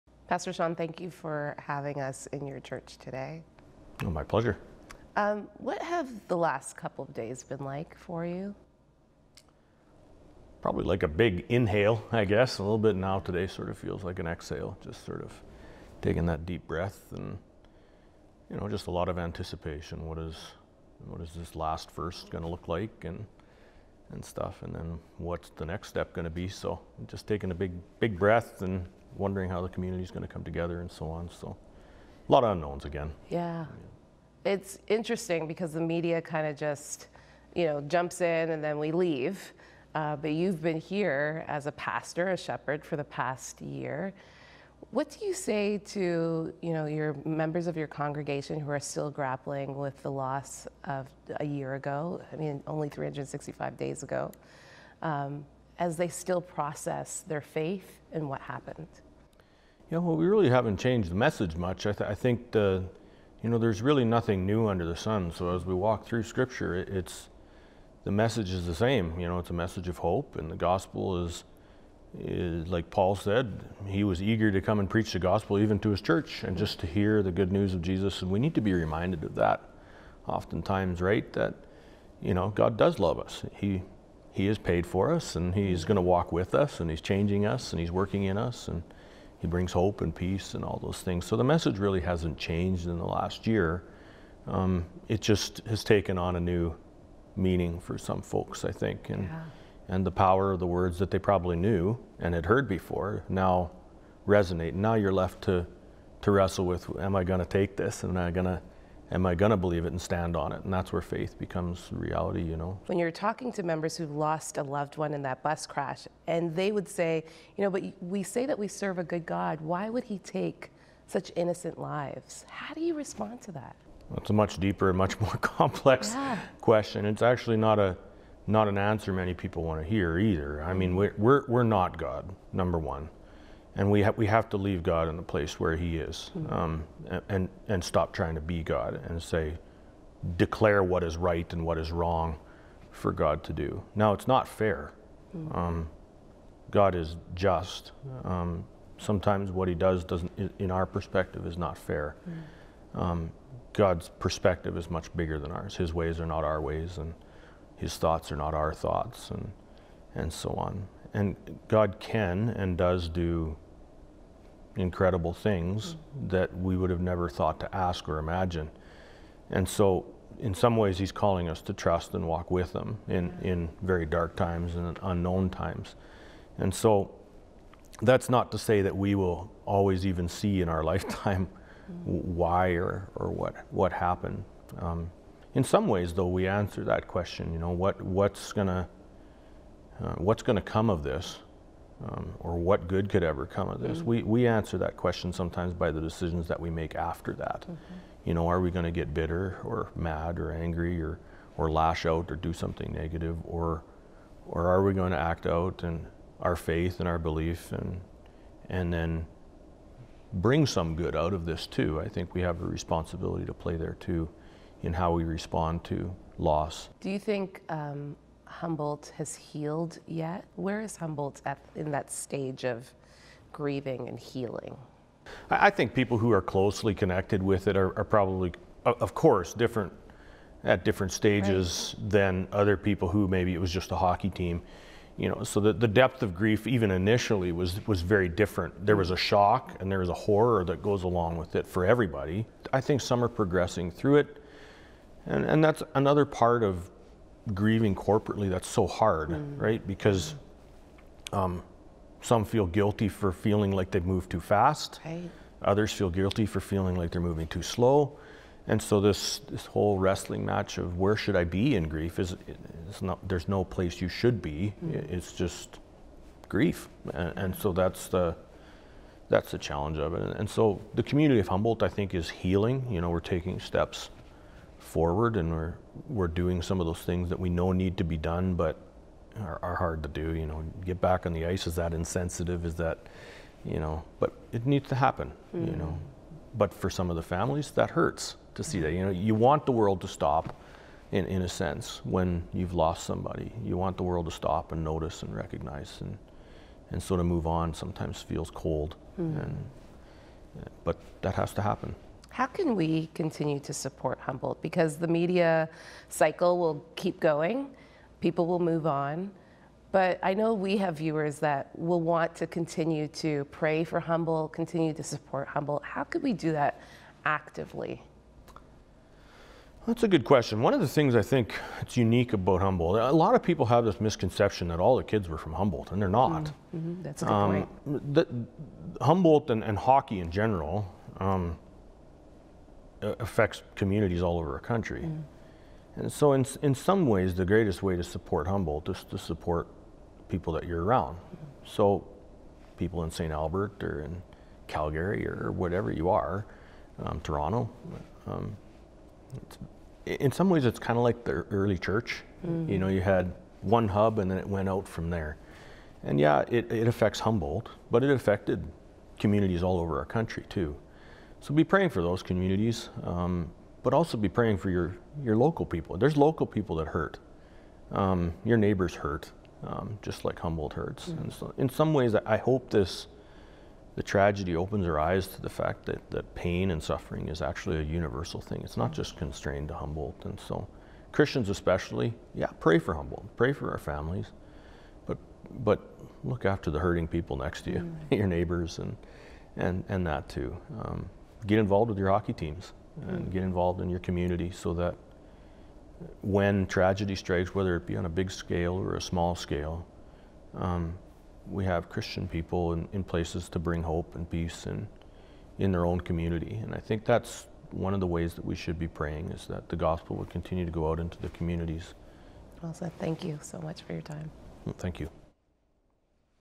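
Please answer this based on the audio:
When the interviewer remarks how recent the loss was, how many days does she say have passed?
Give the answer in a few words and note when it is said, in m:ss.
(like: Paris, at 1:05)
365, at 0:52.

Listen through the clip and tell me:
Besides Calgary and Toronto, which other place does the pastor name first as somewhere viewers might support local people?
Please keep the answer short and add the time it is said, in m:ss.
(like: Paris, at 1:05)
St. Albert, at 5:43.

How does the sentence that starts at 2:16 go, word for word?
um, and and stop trying to be God and say, declare what is right and what is wrong, for God to do.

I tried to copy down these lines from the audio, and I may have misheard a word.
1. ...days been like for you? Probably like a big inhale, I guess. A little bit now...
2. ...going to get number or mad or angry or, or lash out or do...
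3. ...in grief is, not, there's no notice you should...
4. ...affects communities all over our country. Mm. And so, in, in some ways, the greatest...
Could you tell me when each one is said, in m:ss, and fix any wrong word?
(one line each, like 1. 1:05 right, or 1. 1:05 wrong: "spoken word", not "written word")
1. 0:07 right
2. 3:18 wrong: "bitter", not "number"
3. 4:21 wrong: "place", not "notice"
4. 5:33 right.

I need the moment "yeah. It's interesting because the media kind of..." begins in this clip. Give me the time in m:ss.
0:34.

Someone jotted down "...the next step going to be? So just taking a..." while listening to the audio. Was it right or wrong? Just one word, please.
right.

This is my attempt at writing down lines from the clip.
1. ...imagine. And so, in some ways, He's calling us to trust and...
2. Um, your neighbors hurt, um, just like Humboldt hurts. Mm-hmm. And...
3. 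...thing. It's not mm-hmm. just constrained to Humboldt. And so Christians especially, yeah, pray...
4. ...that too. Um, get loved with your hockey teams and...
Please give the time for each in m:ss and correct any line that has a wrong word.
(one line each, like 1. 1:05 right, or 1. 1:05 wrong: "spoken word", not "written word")
1. 2:48 right
2. 6:07 right
3. 6:18 right
4. 6:30 wrong: "involved", not "loved".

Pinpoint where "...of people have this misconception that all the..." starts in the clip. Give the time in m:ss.
5:23.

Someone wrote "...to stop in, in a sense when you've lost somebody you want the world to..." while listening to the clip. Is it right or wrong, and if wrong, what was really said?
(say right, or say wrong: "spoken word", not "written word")
right.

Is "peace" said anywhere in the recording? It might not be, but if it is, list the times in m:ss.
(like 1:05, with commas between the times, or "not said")
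1:30, 6:44.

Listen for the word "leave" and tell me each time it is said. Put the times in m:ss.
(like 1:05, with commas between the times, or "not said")
0:38, 2:14.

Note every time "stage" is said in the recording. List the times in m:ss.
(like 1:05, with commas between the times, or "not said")
3:42, 3:51.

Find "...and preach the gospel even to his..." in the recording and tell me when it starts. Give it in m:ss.
1:14.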